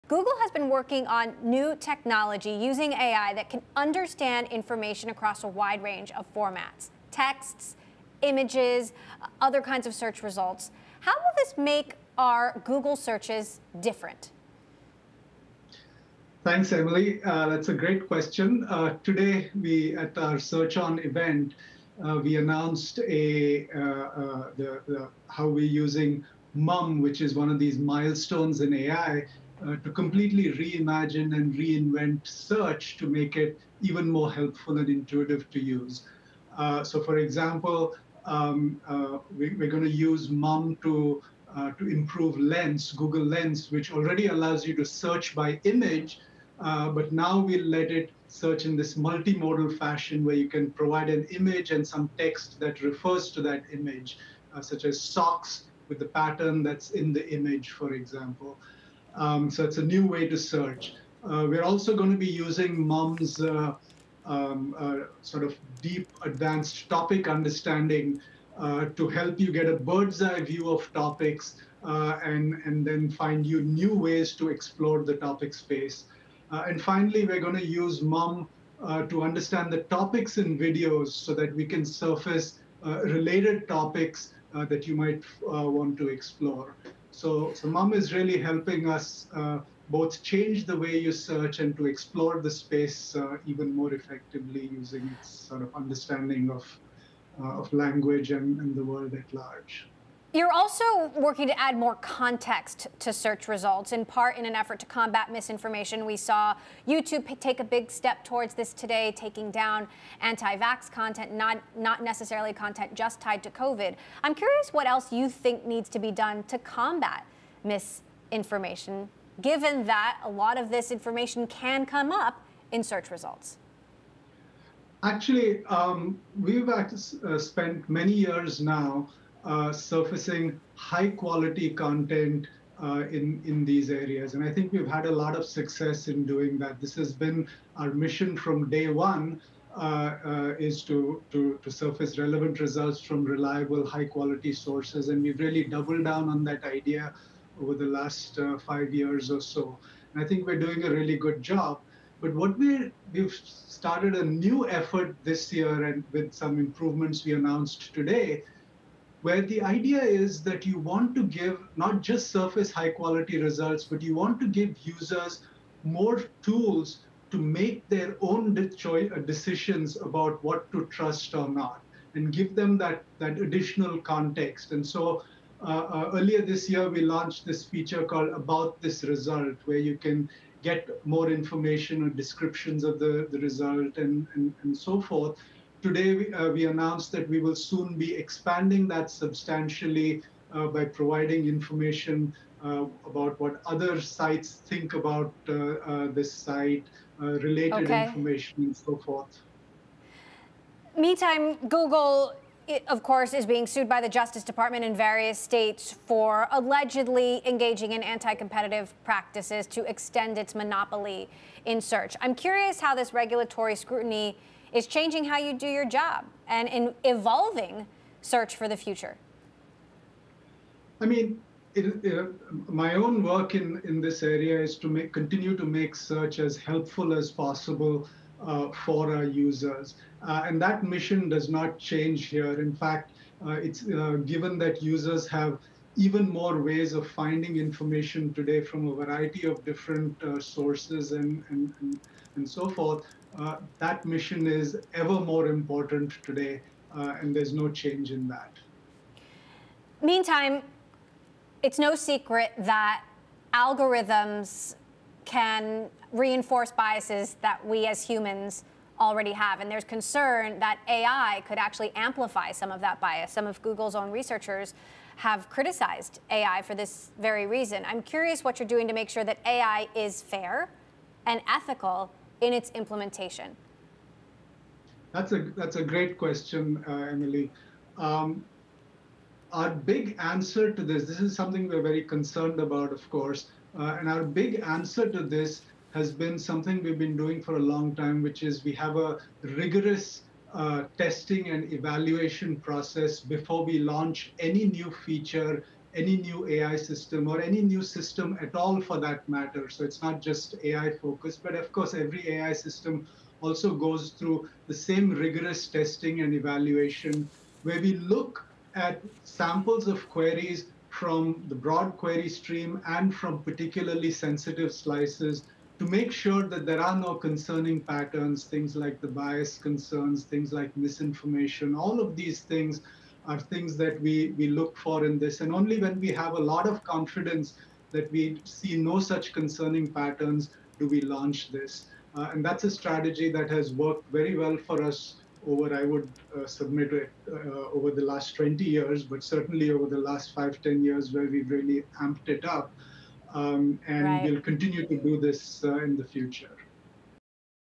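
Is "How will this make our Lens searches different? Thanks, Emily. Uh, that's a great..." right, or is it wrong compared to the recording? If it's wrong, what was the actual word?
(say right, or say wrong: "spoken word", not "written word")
wrong: "Google", not "Lens".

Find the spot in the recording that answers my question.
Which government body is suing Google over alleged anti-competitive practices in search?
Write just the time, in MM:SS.
03:24.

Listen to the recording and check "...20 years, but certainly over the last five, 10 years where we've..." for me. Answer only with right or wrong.
right.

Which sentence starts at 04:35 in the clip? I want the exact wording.
That's a that's a great question, uh, Emily.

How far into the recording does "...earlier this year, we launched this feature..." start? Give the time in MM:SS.
02:56.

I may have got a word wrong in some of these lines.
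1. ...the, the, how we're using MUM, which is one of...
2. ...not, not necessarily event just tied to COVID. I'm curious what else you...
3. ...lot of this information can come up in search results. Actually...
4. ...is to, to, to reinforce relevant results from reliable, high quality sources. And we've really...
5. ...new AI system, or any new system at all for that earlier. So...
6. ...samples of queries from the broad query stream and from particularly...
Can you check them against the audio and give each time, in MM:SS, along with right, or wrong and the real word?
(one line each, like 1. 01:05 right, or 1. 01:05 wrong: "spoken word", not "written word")
1. 00:24 right
2. 01:51 wrong: "content", not "event"
3. 02:00 right
4. 02:20 wrong: "surface", not "reinforce"
5. 04:56 wrong: "matter", not "earlier"
6. 05:09 right.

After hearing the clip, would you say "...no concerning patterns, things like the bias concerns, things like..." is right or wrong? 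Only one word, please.
right.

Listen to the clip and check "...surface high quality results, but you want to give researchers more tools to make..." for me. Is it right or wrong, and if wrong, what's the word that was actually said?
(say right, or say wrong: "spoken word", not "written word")
wrong: "users", not "researchers".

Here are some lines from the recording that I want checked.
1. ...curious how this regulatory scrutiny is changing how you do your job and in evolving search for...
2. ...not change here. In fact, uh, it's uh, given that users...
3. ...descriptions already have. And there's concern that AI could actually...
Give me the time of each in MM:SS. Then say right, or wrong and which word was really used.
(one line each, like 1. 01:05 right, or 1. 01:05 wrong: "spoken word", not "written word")
1. 03:32 right
2. 03:51 right
3. 04:18 wrong: "humans", not "descriptions".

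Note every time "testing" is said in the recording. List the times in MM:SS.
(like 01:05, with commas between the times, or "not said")
04:50, 05:05.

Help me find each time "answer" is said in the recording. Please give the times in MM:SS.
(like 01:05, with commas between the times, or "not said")
04:40, 04:44.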